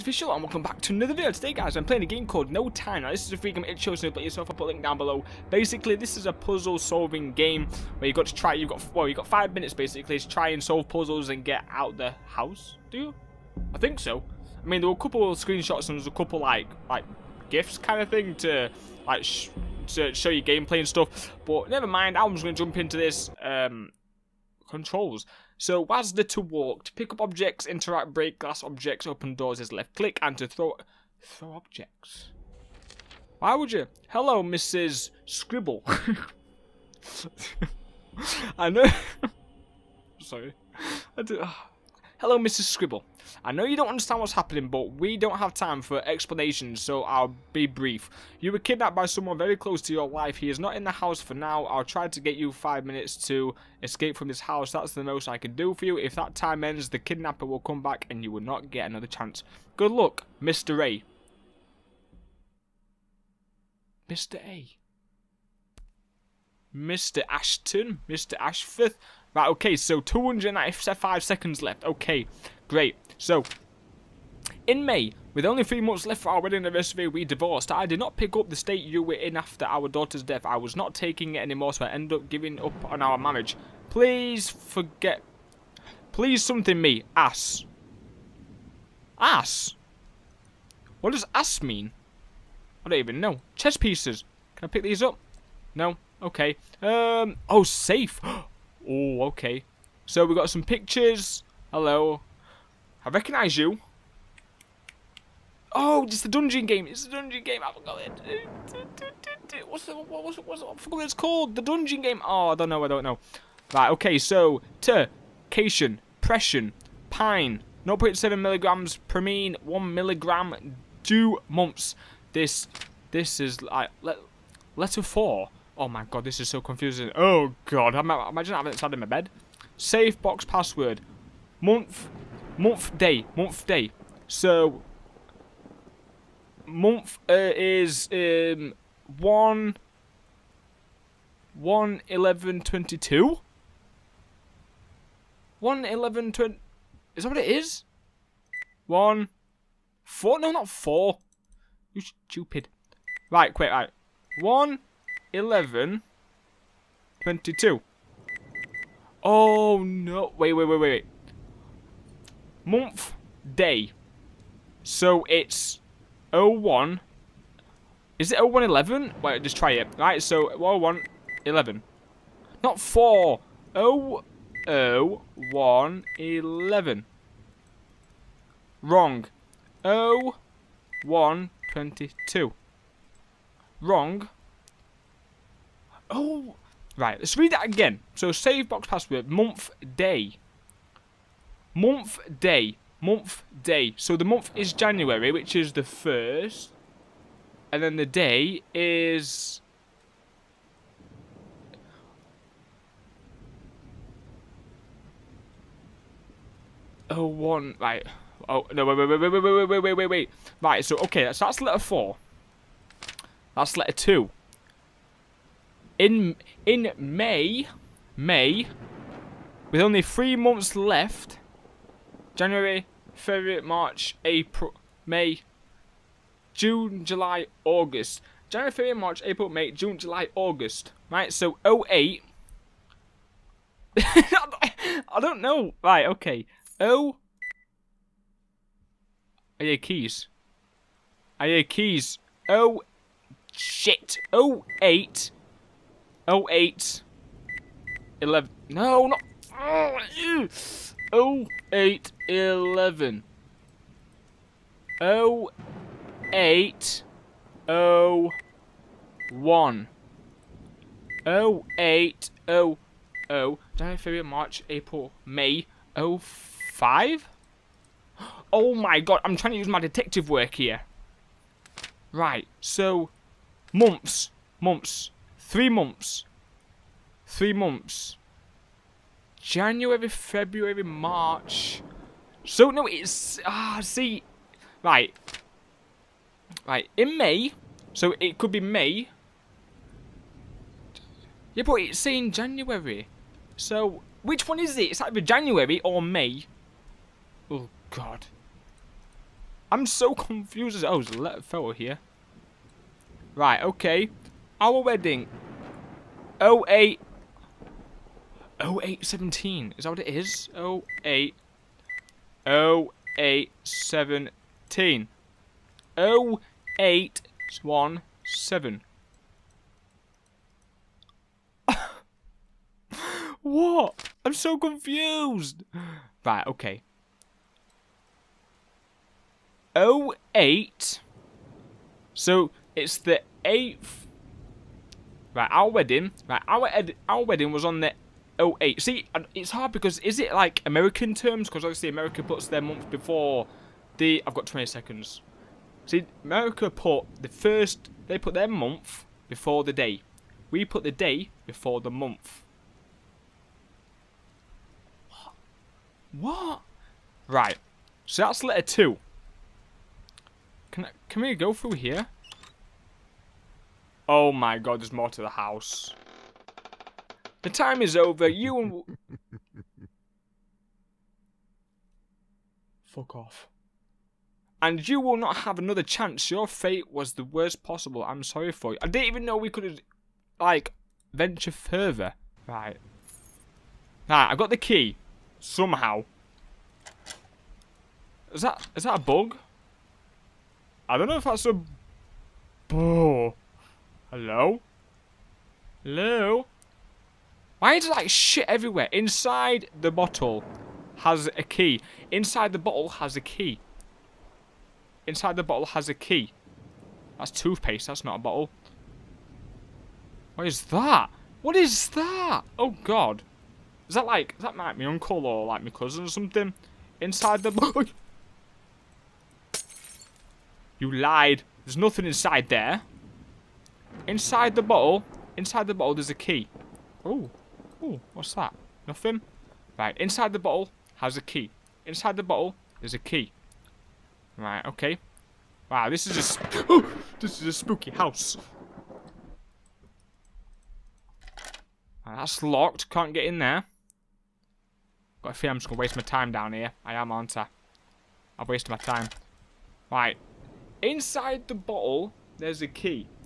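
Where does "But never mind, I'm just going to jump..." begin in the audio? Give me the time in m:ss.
0:21.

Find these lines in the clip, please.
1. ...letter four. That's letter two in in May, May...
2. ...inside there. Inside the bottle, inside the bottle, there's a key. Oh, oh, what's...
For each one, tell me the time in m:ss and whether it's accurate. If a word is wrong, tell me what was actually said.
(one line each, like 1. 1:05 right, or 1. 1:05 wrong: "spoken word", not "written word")
1. 3:31 right
2. 7:02 right.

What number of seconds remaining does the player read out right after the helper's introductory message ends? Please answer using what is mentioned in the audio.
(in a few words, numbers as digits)
295.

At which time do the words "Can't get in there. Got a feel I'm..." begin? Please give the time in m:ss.
7:22.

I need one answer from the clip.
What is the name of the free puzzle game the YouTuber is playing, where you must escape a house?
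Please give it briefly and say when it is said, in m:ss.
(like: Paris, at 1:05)
No Time, at 0:02.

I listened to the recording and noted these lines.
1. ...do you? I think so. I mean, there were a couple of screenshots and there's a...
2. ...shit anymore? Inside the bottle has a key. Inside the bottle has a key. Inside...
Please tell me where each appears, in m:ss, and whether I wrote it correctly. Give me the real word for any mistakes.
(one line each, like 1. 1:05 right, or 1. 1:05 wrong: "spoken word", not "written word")
1. 0:12 right
2. 6:38 wrong: "everywhere", not "anymore".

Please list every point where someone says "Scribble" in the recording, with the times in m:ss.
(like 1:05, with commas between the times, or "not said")
0:35, 0:42.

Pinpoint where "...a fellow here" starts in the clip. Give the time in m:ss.
5:01.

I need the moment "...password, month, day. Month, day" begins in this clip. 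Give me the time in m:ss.
3:08.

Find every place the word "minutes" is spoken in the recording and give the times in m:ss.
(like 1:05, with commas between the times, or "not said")
0:09, 0:52.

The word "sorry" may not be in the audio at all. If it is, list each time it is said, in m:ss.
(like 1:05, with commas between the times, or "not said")
0:40, 6:18.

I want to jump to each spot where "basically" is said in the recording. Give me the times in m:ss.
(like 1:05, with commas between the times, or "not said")
0:05, 0:09.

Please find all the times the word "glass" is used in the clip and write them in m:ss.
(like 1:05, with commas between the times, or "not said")
0:28.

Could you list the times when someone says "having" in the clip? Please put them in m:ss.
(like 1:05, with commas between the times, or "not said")
2:08.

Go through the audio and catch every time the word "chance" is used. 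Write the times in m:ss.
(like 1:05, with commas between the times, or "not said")
0:59, 6:15.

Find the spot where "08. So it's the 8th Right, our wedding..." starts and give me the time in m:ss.
5:29.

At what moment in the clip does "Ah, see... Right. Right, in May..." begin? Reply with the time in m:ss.
4:43.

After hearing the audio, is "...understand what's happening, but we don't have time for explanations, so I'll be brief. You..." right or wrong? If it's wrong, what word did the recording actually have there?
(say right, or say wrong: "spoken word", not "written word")
right.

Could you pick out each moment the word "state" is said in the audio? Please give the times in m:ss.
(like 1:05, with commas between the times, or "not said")
1:18.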